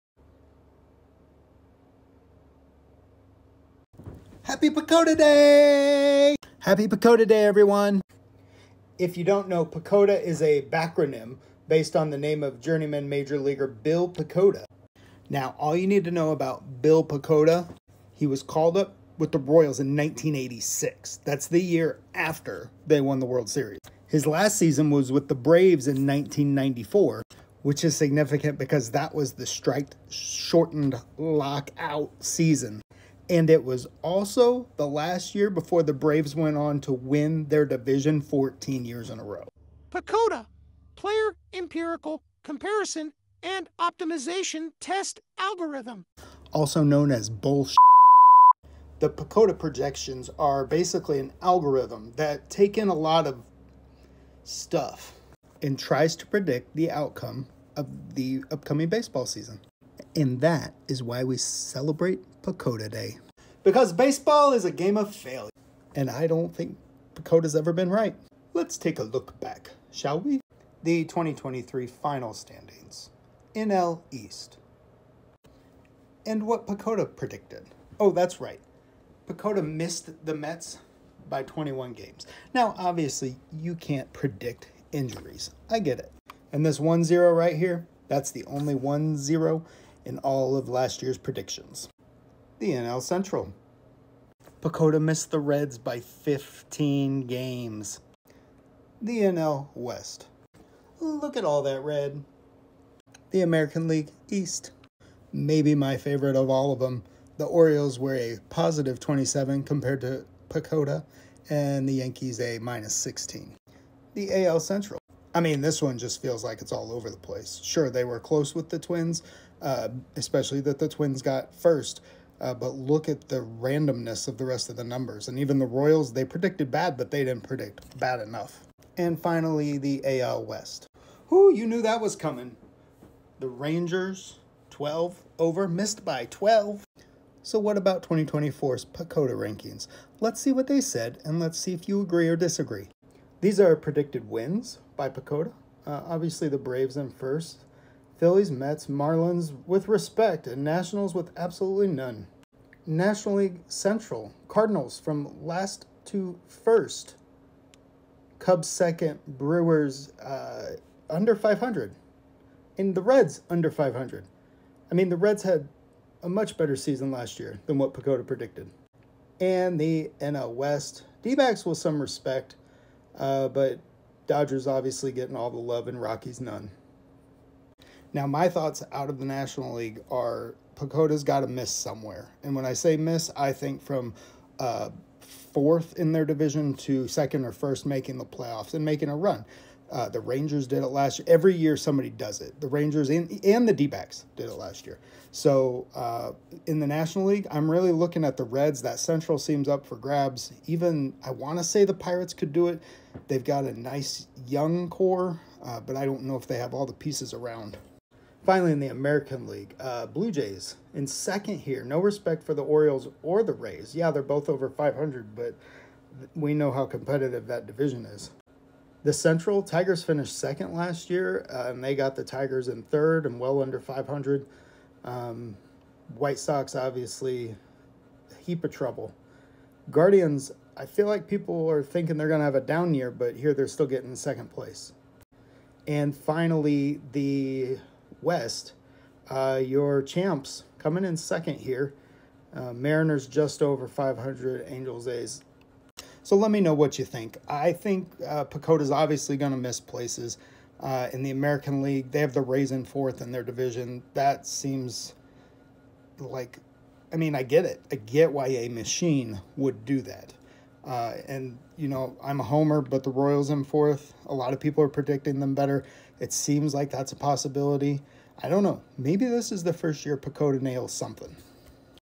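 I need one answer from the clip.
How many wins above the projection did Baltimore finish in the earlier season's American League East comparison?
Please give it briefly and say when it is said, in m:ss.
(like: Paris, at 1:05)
27, at 1:48.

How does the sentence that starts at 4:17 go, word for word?
I get why a machine would do that.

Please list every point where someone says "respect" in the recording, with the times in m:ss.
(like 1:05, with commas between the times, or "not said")
2:29, 2:51, 3:31.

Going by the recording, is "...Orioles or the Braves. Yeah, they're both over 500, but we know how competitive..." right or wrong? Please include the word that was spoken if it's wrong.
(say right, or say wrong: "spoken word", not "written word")
wrong: "Rays", not "Braves".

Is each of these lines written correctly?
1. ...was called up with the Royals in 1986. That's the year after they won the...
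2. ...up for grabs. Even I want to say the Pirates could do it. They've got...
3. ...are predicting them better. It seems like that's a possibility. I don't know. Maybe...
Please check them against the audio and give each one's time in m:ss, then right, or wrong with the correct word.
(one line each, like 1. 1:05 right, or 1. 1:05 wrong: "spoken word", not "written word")
1. 0:18 right
2. 3:19 right
3. 4:24 right.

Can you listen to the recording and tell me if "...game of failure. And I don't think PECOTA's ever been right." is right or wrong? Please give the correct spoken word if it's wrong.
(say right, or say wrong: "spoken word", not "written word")
right.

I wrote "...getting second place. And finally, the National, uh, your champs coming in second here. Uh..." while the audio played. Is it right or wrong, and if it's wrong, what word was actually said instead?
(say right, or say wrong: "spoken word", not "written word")
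wrong: "West", not "National".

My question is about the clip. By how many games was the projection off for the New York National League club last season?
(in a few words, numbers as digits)
21.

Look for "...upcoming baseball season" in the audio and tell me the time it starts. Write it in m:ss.
0:58.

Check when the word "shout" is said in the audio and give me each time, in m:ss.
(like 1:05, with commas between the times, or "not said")
not said.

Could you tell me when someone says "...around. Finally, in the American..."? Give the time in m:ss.
3:27.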